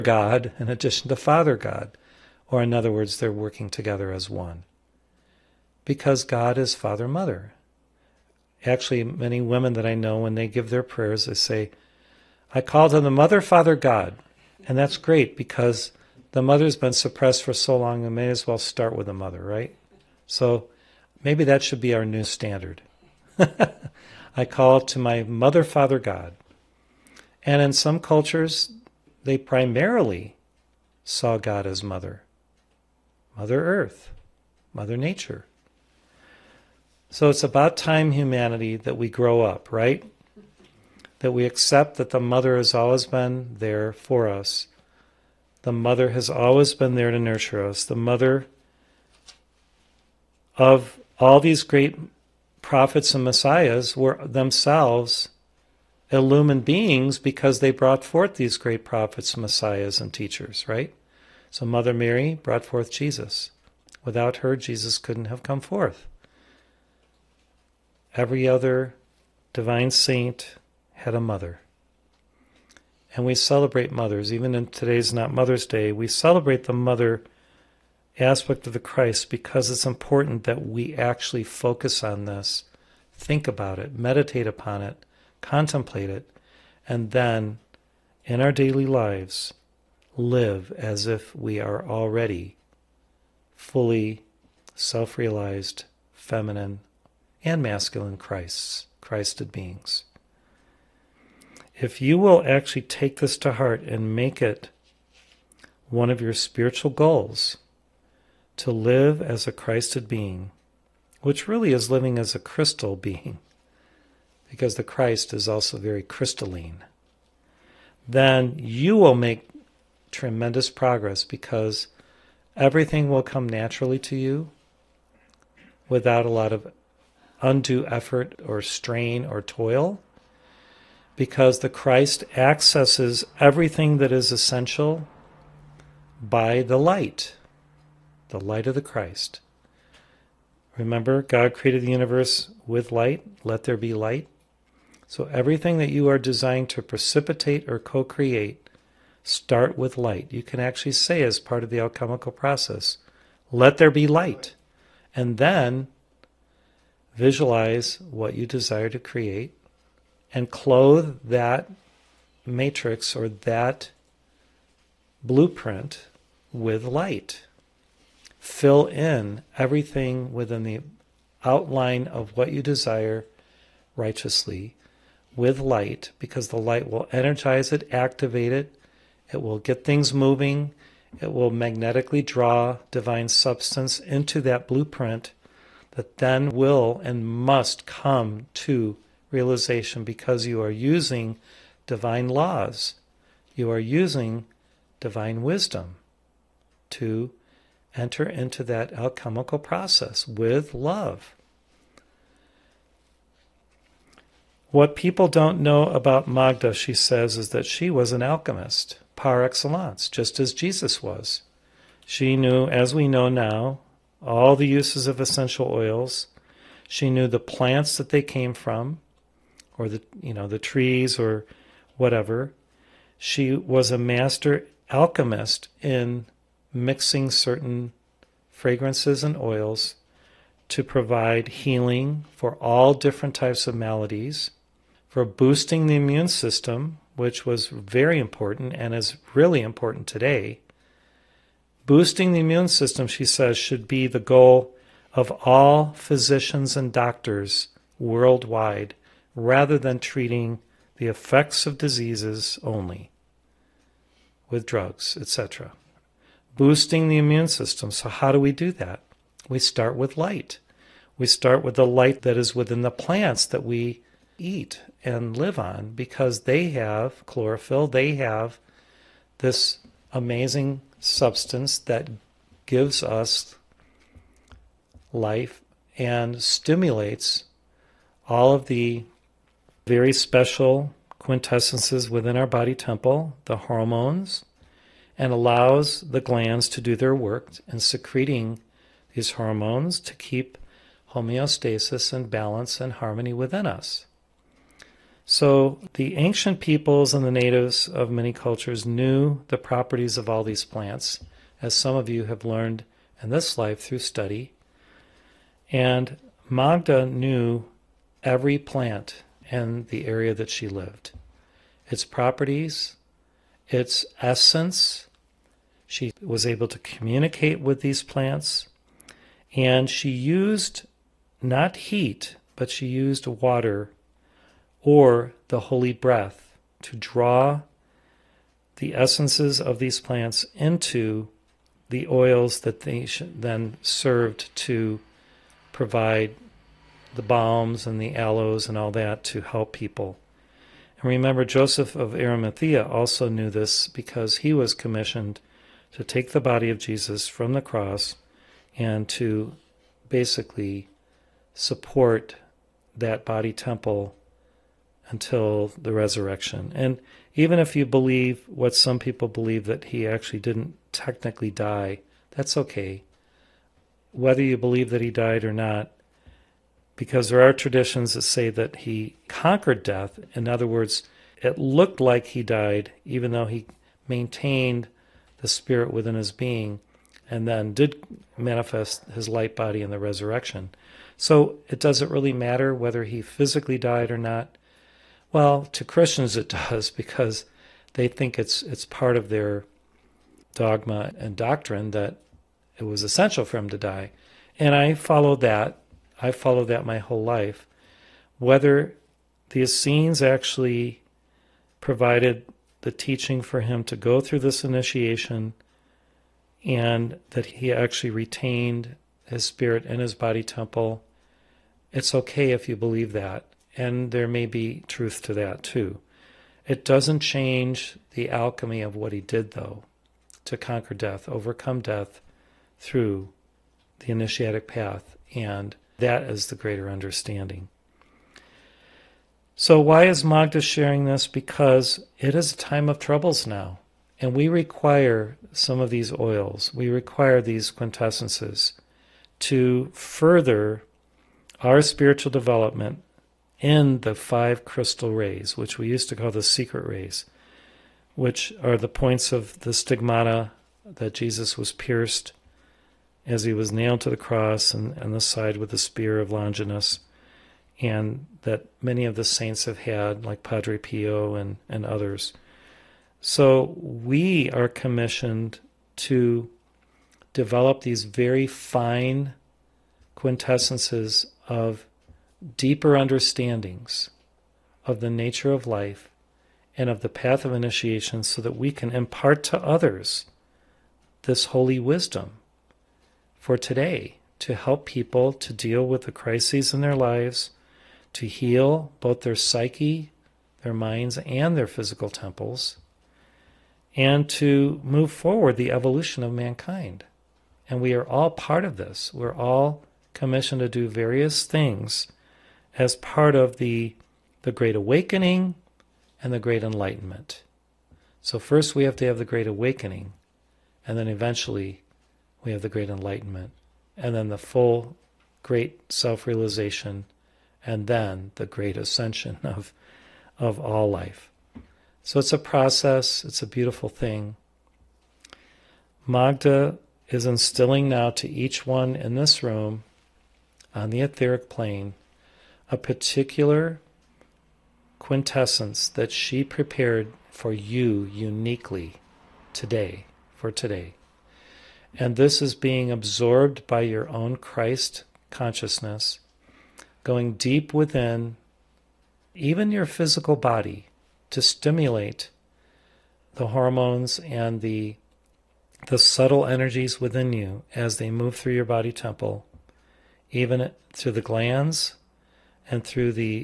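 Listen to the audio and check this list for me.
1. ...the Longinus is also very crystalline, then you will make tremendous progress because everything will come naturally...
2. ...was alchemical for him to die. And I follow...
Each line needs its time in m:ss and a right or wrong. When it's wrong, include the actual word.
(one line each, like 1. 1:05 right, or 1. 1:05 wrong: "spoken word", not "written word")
1. 1:54 wrong: "Christ", not "Longinus"
2. 6:32 wrong: "essential", not "alchemical".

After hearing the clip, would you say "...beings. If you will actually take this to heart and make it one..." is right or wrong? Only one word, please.
right.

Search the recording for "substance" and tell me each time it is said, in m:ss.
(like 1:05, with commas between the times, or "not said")
3:03, 4:30.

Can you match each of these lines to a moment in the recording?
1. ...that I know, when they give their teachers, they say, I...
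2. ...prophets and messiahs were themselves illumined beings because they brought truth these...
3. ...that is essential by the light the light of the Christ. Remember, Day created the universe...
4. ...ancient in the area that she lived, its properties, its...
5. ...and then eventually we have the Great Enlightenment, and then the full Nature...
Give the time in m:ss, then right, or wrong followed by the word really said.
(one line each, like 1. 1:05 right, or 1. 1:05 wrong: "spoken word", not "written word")
1. 0:09 wrong: "prayers", not "teachers"
2. 0:52 wrong: "forth", not "truth"
3. 2:13 wrong: "God", not "Day"
4. 5:08 wrong: "plant", not "ancient"
5. 8:30 wrong: "Great", not "Nature".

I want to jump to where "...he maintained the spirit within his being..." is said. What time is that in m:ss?
6:13.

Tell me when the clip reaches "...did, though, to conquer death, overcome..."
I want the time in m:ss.
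6:59.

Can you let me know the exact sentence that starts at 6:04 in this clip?
Whether you believe that he died or not, because there are traditions that say that he conquered death.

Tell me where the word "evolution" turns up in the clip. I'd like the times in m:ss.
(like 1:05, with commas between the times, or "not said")
8:15.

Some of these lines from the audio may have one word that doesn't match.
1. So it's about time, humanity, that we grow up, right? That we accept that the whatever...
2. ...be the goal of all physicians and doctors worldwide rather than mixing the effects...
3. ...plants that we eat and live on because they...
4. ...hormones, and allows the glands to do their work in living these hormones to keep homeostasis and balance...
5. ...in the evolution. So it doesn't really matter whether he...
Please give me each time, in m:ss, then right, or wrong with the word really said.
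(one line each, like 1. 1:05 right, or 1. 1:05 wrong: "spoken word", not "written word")
1. 0:37 wrong: "mother", not "whatever"
2. 4:03 wrong: "treating", not "mixing"
3. 4:22 right
4. 4:43 wrong: "secreting", not "living"
5. 6:19 wrong: "resurrection", not "evolution".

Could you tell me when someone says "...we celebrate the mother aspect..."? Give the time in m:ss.
1:15.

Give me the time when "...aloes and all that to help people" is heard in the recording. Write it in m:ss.
5:38.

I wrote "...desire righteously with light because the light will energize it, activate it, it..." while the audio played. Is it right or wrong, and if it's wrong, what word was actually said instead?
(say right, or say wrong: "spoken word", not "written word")
right.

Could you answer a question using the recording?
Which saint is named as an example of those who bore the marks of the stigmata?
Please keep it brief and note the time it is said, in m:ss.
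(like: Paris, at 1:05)
Padre Pio, at 7:40.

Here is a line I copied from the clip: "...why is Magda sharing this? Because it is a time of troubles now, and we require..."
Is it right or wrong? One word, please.
right.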